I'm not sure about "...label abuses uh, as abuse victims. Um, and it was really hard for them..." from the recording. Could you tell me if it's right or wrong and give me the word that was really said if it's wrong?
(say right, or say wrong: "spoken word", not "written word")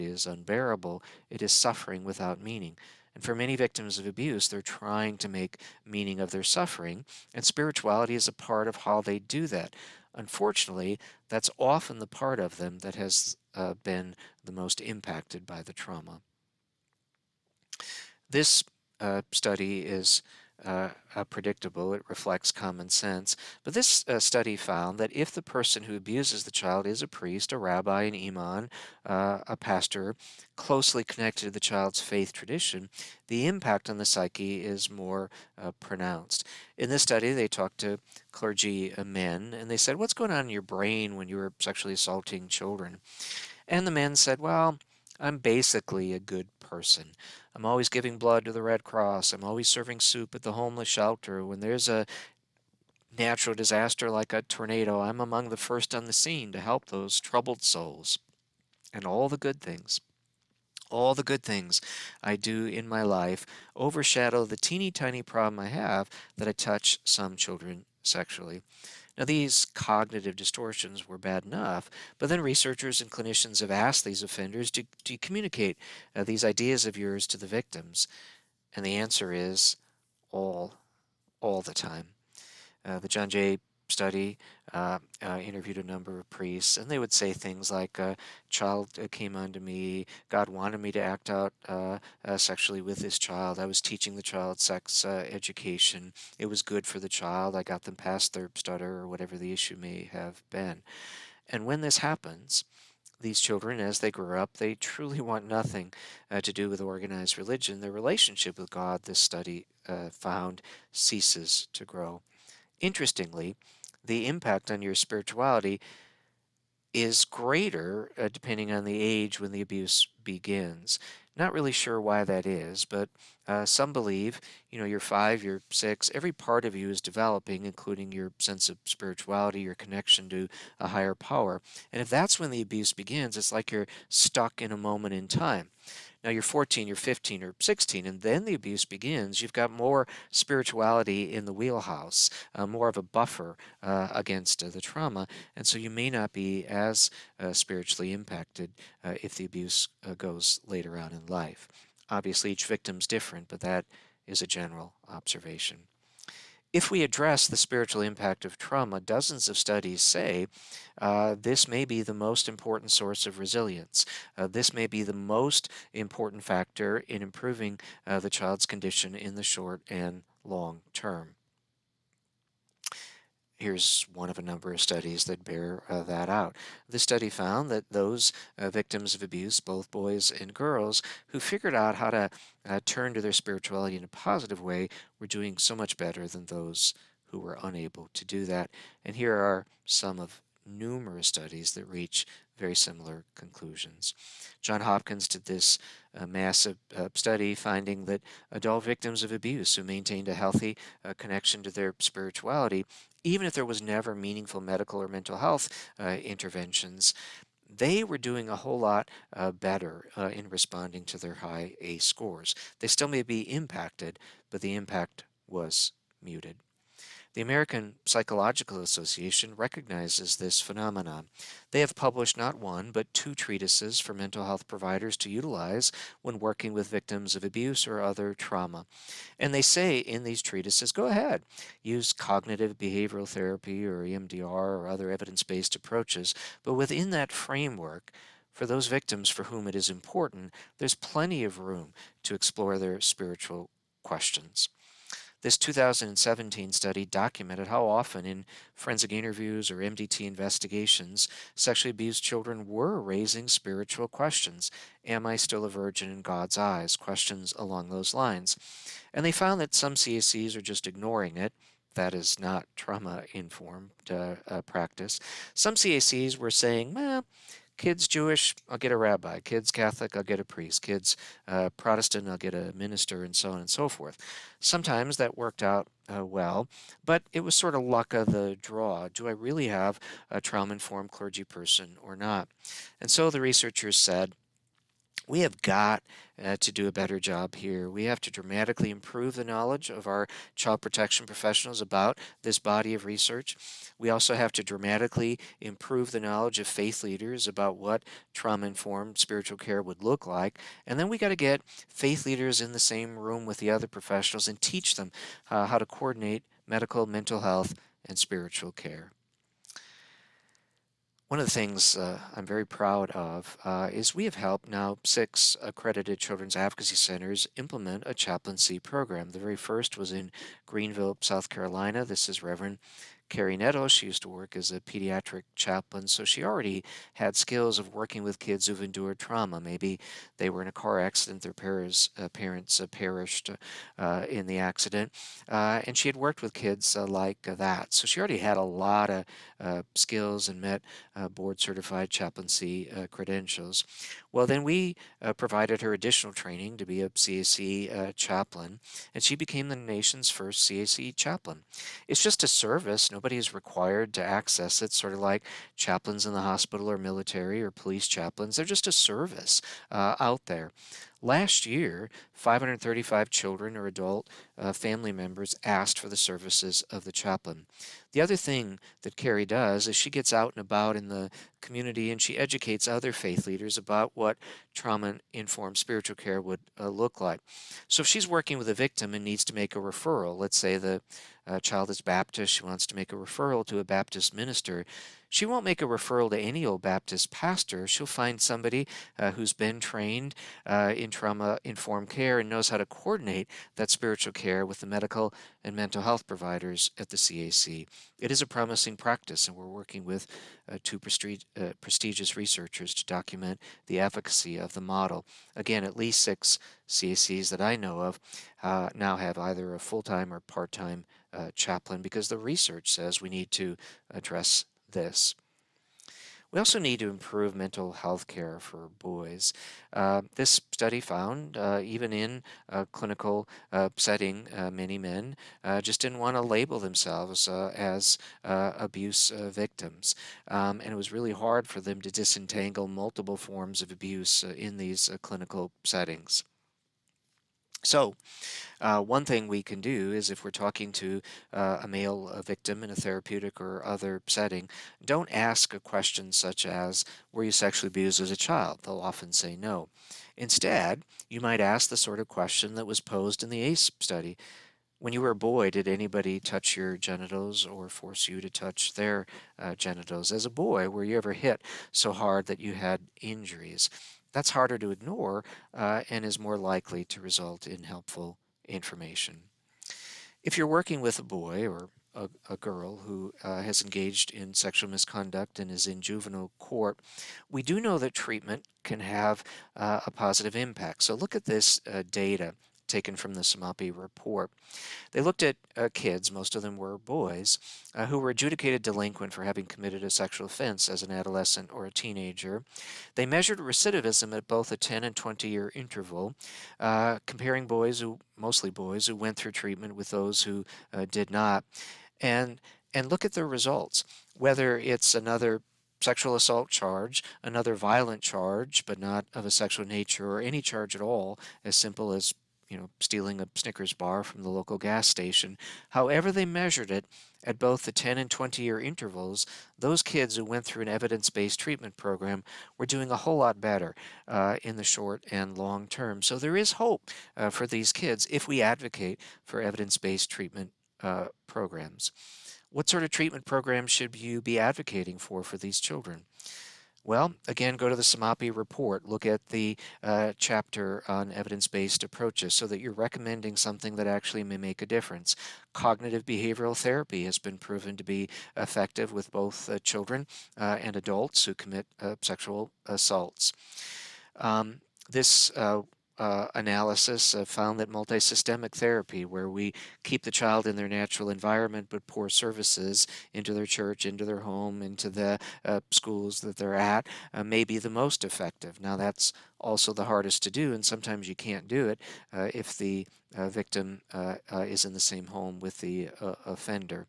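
wrong: "themselves", not "abuses".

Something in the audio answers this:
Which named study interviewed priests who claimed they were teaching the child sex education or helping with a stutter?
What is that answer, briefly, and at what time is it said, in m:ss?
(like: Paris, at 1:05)
John Jay study, at 1:23.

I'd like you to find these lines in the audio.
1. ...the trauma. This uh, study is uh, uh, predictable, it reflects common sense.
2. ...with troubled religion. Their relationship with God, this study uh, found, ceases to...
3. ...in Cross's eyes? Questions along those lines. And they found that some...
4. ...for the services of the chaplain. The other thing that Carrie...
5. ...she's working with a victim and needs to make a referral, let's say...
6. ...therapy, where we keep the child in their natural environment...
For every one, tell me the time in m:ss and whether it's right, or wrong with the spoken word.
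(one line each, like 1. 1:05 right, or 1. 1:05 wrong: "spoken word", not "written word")
1. 0:15 right
2. 1:46 wrong: "organized", not "troubled"
3. 4:16 wrong: "God", not "Cross"
4. 6:05 right
5. 6:18 right
6. 9:18 right.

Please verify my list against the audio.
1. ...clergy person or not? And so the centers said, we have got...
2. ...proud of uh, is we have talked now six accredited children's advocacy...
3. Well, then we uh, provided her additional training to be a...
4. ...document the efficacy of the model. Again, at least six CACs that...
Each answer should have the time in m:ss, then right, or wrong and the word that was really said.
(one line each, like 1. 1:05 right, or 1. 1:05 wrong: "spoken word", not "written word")
1. 4:41 wrong: "researchers", not "centers"
2. 5:12 wrong: "helped", not "talked"
3. 5:44 right
4. 6:43 right.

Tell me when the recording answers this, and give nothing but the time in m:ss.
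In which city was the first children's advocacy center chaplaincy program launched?
5:20.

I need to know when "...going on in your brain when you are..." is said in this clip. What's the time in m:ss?
0:40.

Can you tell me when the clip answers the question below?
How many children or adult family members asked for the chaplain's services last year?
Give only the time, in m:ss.
6:02.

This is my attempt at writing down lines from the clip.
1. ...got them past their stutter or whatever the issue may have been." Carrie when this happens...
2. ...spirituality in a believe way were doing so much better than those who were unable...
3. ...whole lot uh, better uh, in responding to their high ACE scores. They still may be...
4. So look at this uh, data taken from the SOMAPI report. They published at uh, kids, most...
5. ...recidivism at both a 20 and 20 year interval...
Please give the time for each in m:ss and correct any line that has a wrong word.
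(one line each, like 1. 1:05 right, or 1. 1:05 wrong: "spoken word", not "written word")
1. 1:37 wrong: "And", not "Carrie"
2. 3:03 wrong: "positive", not "believe"
3. 3:28 right
4. 8:01 wrong: "looked", not "published"
5. 8:13 wrong: "10", not "20".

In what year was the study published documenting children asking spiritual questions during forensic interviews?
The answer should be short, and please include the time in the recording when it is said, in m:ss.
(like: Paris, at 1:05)
2017, at 4:05.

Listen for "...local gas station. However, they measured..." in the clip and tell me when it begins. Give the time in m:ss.
8:34.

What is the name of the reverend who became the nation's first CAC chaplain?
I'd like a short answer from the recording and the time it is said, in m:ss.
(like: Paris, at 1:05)
Carrie Nettles, at 5:23.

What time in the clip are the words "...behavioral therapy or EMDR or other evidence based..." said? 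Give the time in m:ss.
3:52.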